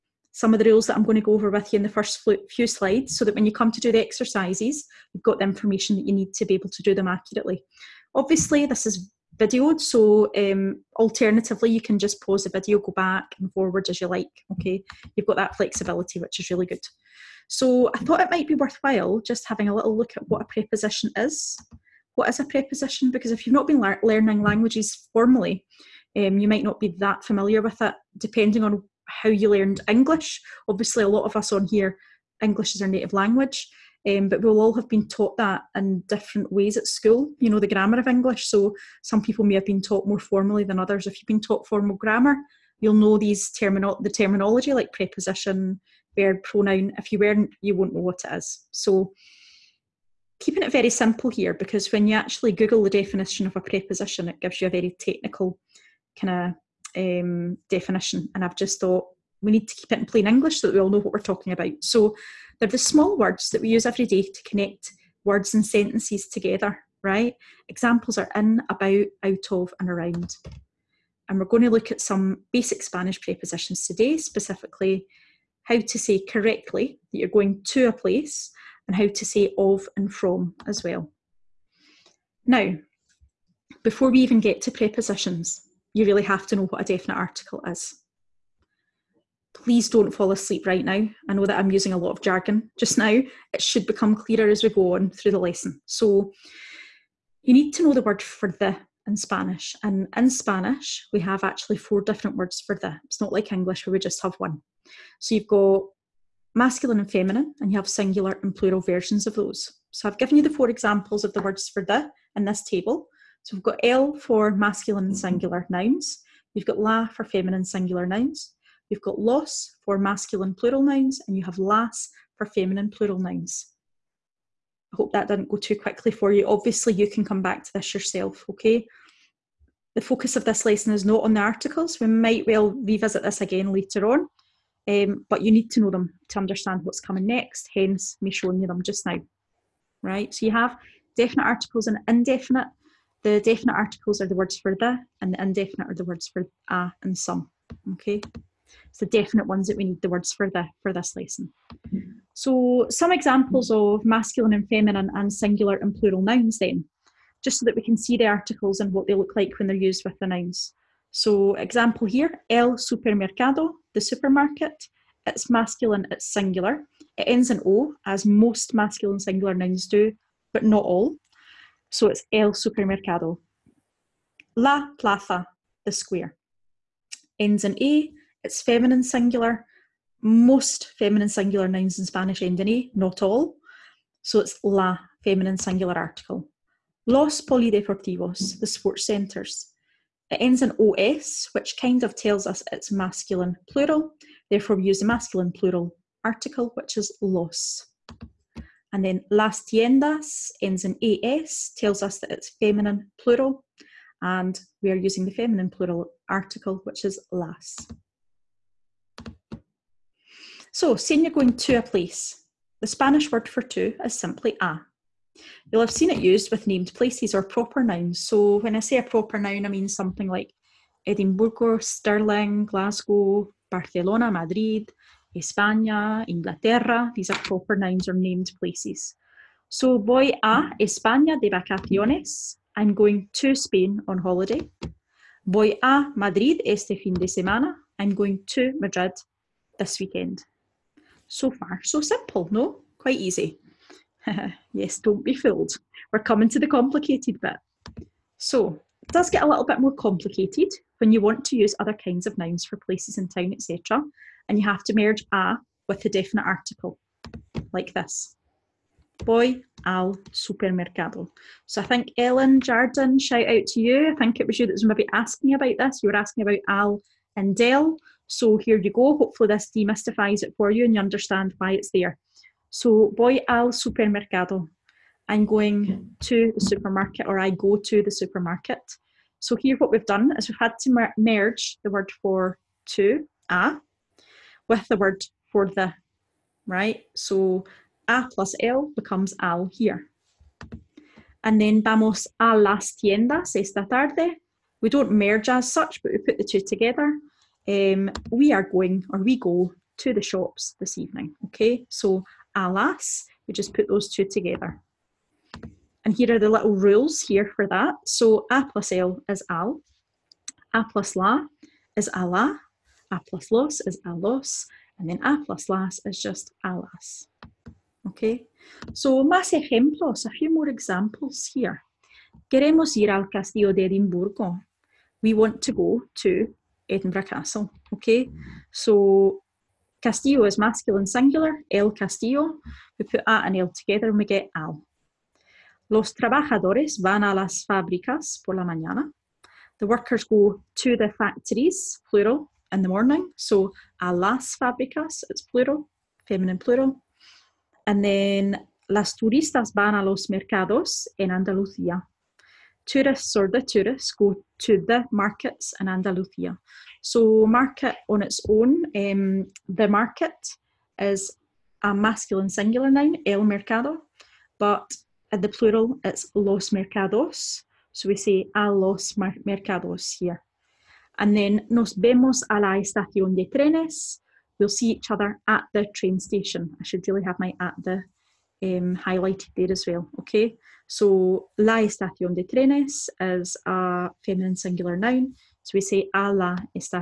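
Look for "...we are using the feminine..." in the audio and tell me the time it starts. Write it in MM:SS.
03:24.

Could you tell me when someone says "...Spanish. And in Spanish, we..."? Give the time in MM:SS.
01:39.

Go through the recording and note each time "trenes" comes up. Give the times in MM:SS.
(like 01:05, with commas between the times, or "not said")
06:13, 06:22.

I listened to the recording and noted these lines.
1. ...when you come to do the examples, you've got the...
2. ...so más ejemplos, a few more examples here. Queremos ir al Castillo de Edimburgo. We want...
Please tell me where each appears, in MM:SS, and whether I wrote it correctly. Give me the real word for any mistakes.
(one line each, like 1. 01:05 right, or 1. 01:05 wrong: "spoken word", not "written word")
1. 00:03 wrong: "exercises", not "examples"
2. 05:18 right.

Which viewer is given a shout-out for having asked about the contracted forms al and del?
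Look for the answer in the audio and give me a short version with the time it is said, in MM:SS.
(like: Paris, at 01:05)
Ellen Jardin, at 04:22.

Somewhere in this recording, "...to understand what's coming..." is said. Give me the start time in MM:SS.
02:16.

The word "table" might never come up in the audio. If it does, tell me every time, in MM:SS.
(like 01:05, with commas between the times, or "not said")
01:52.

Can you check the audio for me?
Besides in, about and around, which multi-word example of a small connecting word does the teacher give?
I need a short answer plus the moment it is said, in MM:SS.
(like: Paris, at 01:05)
out of, at 01:09.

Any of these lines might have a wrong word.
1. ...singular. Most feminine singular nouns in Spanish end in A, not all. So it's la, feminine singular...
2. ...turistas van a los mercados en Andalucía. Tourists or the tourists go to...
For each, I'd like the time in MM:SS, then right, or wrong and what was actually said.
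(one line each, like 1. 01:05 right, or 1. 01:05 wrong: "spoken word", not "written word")
1. 02:59 right
2. 05:49 right.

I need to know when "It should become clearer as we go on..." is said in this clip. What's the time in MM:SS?
01:33.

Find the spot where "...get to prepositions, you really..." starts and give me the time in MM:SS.
01:24.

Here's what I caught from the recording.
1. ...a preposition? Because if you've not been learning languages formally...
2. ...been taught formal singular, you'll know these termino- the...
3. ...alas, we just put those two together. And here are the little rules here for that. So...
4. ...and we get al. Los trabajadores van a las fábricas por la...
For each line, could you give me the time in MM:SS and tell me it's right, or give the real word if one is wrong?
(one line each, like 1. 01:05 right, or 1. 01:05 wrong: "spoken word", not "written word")
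1. 00:22 right
2. 00:41 wrong: "grammar", not "singular"
3. 05:02 right
4. 05:34 right.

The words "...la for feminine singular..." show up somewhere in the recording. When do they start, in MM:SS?
01:56.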